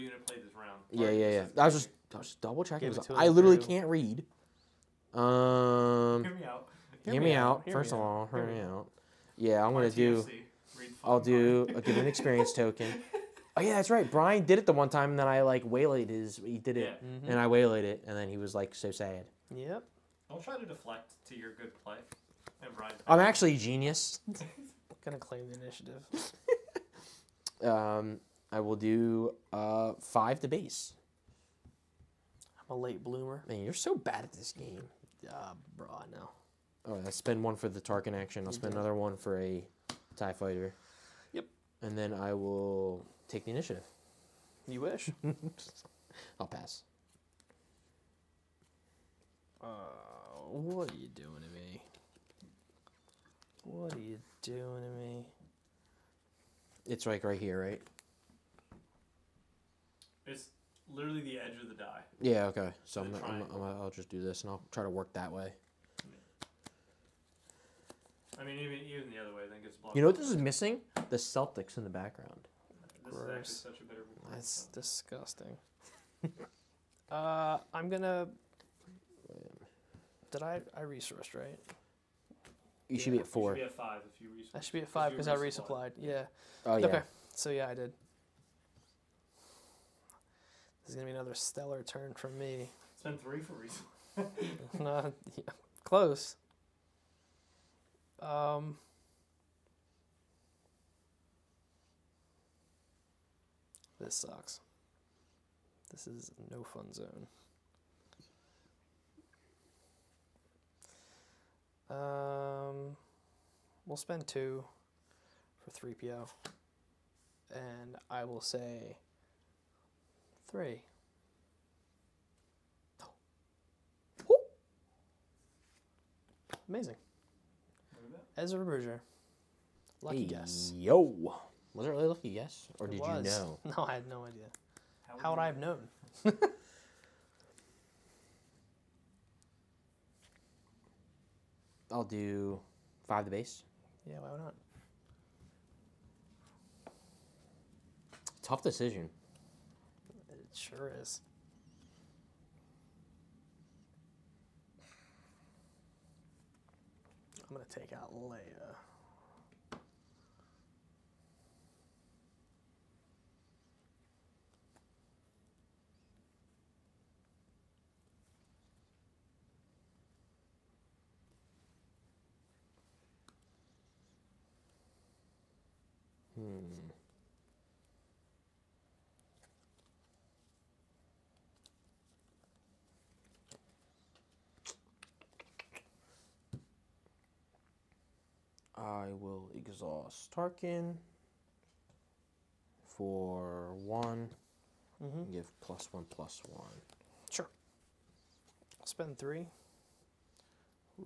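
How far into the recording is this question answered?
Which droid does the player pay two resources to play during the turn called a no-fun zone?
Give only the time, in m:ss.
1:55.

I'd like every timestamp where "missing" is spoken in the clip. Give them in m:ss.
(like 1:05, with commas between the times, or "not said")
1:10.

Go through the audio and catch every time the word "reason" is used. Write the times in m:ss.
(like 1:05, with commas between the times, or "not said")
1:33.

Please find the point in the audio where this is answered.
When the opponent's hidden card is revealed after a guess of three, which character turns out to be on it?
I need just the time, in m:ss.
2:08.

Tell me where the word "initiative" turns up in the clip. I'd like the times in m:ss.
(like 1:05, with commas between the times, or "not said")
0:25, 0:43.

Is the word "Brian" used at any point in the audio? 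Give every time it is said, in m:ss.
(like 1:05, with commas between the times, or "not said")
0:14, 0:22.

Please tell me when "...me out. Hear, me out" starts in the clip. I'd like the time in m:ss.
0:06.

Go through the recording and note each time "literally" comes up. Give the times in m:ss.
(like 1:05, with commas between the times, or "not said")
0:03, 1:00.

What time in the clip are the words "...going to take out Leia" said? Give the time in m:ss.
2:37.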